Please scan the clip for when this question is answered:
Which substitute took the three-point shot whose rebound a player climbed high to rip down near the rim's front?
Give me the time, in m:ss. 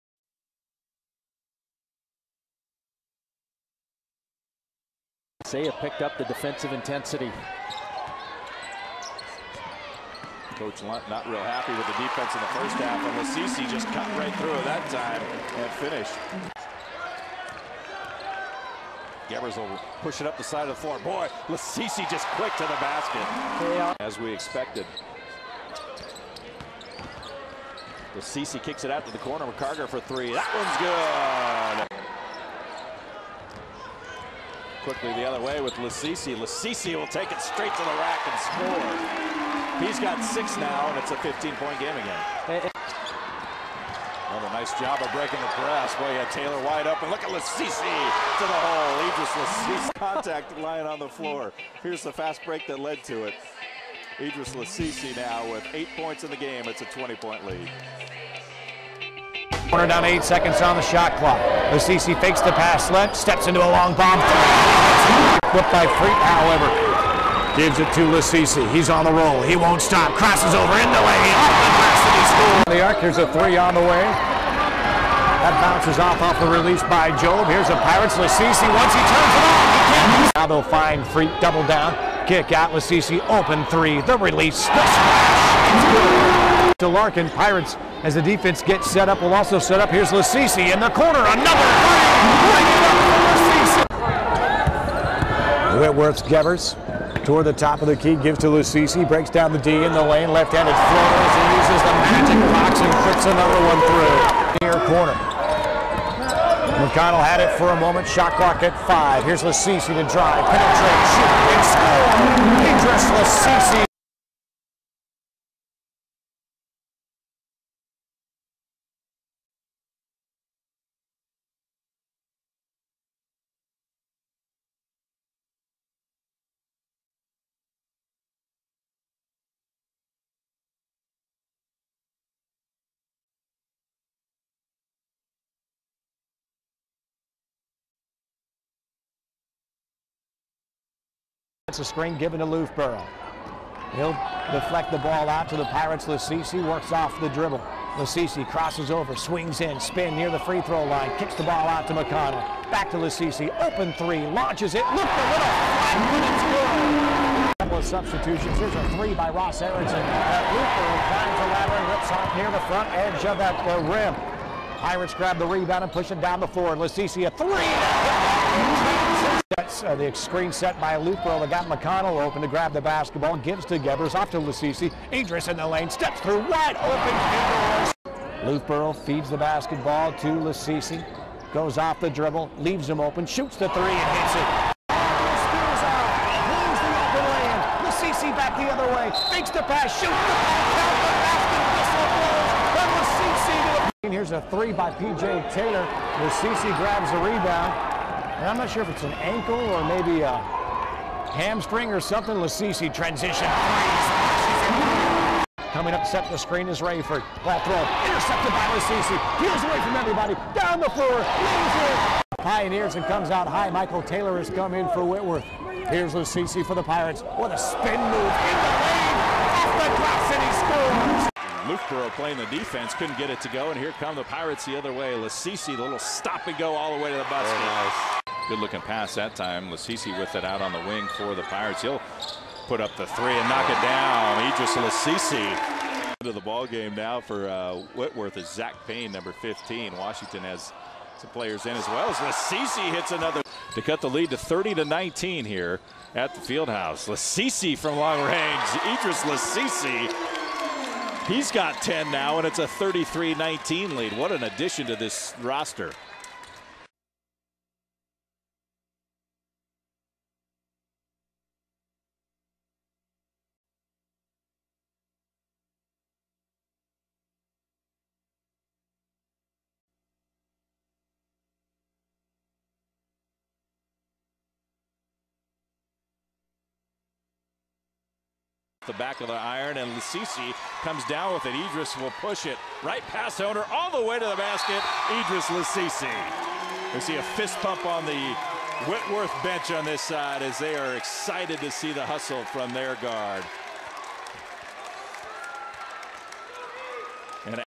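2:39.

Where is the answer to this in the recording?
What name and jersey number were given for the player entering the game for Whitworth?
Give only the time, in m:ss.
3:58.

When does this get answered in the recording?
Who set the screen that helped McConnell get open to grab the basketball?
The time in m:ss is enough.
2:50.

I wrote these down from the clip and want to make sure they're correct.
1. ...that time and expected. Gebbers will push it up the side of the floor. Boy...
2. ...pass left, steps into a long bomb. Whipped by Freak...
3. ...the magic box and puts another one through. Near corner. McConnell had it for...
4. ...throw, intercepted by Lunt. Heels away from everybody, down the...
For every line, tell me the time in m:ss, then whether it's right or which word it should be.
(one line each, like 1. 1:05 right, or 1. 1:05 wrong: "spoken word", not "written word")
1. 0:14 wrong: "finished", not "expected"
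2. 1:02 right
3. 1:41 right
4. 3:27 wrong: "Lasisi", not "Lunt".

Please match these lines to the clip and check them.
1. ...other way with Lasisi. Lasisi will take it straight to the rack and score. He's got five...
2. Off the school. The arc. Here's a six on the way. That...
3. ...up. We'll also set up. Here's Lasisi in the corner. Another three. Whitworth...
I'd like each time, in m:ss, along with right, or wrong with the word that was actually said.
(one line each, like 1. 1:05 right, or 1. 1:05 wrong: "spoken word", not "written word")
1. 0:35 wrong: "six", not "five"
2. 1:11 wrong: "three", not "six"
3. 1:29 right.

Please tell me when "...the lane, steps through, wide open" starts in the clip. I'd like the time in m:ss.
2:55.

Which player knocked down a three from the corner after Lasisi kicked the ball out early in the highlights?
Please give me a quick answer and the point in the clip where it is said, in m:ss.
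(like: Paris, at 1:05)
McCarger, at 0:29.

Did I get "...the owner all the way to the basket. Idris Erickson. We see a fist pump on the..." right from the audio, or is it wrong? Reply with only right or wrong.
wrong.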